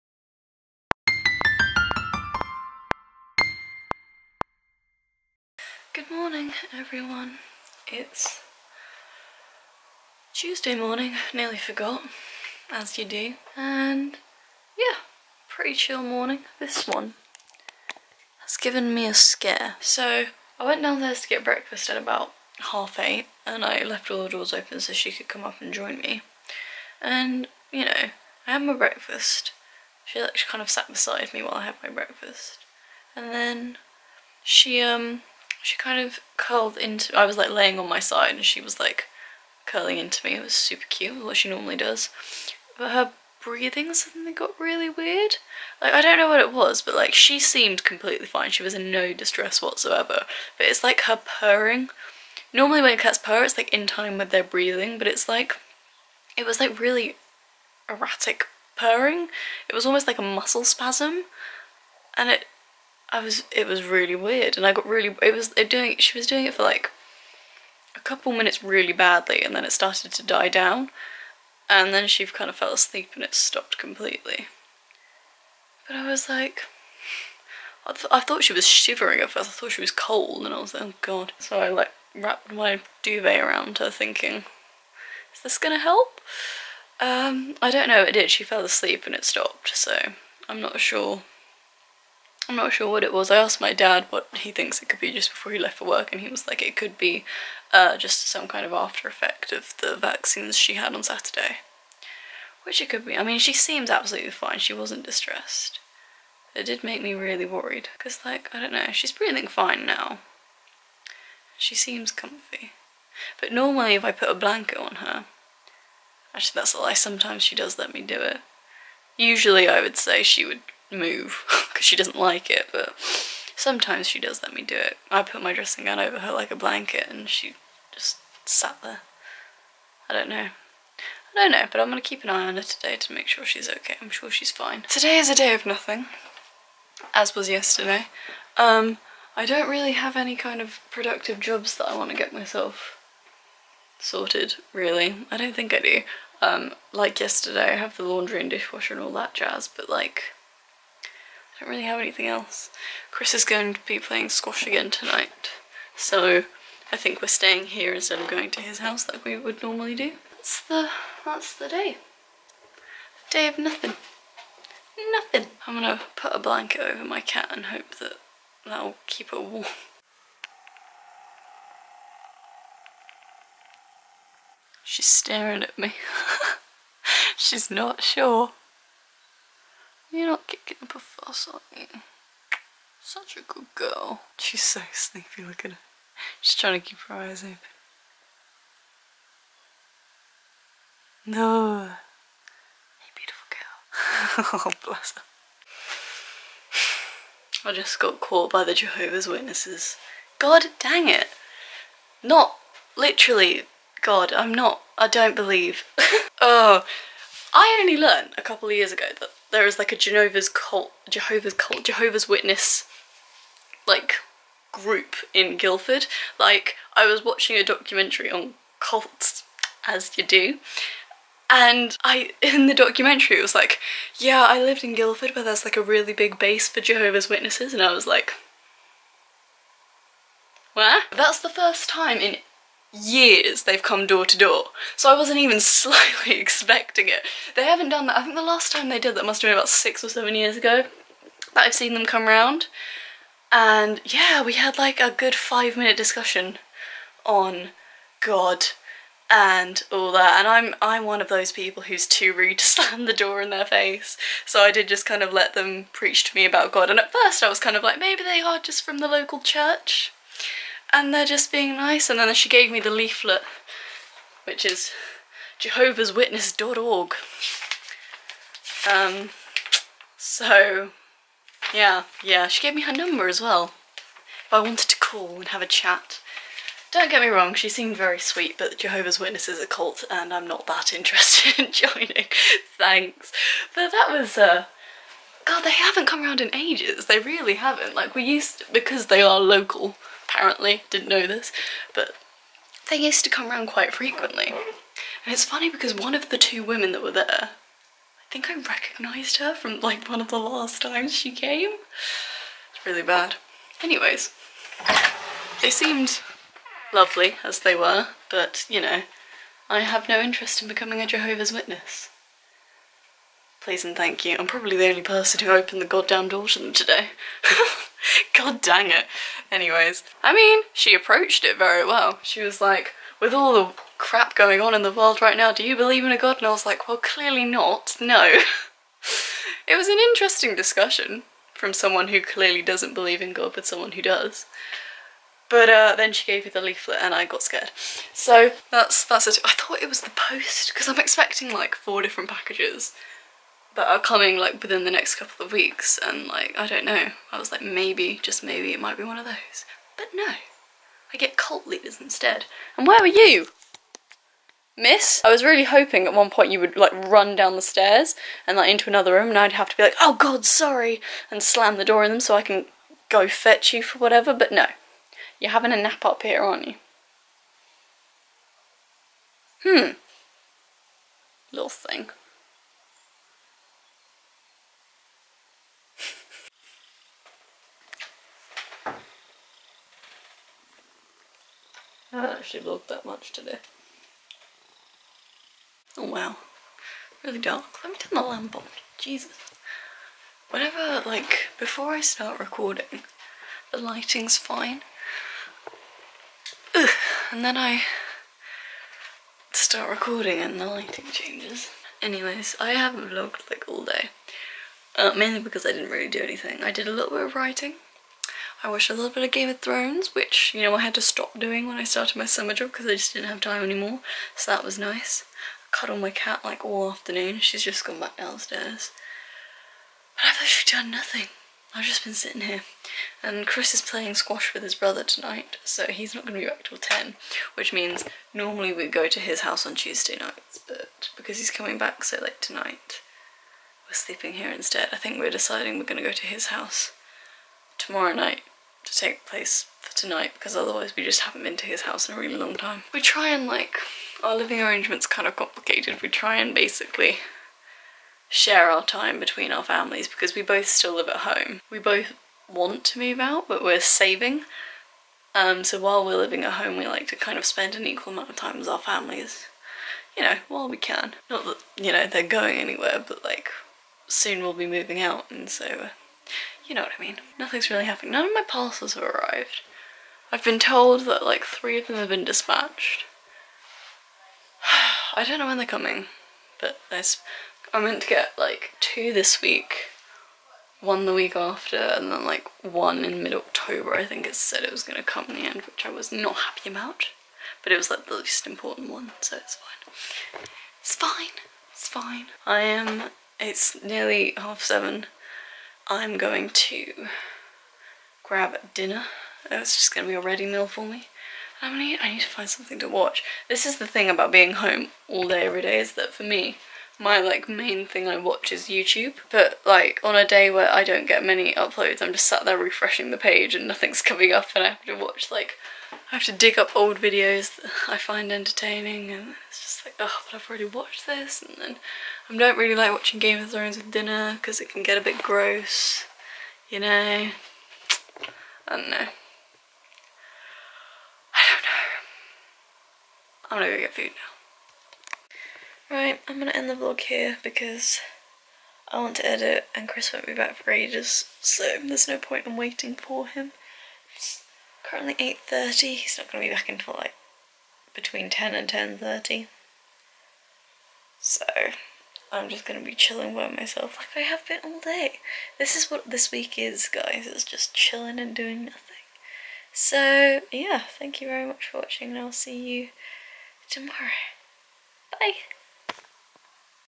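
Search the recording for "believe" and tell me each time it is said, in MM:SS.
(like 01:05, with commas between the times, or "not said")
03:25, 05:25, 05:32.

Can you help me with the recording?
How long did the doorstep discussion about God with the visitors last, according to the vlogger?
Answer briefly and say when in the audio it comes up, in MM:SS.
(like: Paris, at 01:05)
5 minutes, at 04:05.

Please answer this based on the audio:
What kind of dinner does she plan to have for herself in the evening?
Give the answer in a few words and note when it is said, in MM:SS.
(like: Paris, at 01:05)
A ready meal, at 08:20.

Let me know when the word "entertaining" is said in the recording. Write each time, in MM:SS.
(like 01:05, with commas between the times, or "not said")
08:38.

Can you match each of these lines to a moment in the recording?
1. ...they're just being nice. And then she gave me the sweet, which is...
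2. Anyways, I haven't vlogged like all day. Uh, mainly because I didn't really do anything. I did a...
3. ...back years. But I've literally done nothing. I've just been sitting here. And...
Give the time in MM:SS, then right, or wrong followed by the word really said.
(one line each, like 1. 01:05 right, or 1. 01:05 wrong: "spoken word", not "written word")
1. 04:21 wrong: "leaflet", not "sweet"
2. 06:42 right
3. 06:57 wrong: "downstairs", not "years".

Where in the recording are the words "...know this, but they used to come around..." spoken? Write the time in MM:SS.
04:51.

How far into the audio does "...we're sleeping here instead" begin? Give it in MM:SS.
07:13.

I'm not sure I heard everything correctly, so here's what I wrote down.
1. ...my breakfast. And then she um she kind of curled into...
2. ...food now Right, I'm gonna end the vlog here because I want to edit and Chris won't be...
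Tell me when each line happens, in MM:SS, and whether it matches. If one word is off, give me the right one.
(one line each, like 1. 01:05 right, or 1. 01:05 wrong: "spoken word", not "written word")
1. 00:31 right
2. 08:53 right.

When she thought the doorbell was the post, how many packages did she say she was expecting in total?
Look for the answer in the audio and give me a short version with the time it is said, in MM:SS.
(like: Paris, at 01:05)
4, at 05:41.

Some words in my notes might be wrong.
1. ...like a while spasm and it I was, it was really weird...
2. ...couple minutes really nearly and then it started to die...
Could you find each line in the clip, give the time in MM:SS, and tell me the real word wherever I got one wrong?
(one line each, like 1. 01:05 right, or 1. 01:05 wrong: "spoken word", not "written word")
1. 01:00 wrong: "muscle", not "while"
2. 01:07 wrong: "badly", not "nearly".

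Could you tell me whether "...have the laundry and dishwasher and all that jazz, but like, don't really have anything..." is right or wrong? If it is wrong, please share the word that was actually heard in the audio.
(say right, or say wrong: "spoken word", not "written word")
right.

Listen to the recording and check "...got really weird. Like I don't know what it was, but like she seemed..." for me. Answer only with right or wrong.
right.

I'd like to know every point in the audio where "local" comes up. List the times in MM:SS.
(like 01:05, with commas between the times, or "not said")
04:19, 04:49.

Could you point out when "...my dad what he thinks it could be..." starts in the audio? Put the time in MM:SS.
01:33.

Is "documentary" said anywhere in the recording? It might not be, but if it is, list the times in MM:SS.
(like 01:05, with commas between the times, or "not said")
03:37, 03:42.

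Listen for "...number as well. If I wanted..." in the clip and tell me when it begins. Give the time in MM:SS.
04:32.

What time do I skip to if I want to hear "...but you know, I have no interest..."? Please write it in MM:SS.
05:08.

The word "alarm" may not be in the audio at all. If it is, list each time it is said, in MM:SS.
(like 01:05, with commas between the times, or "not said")
not said.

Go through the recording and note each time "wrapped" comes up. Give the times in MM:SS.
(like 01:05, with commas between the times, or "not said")
01:22.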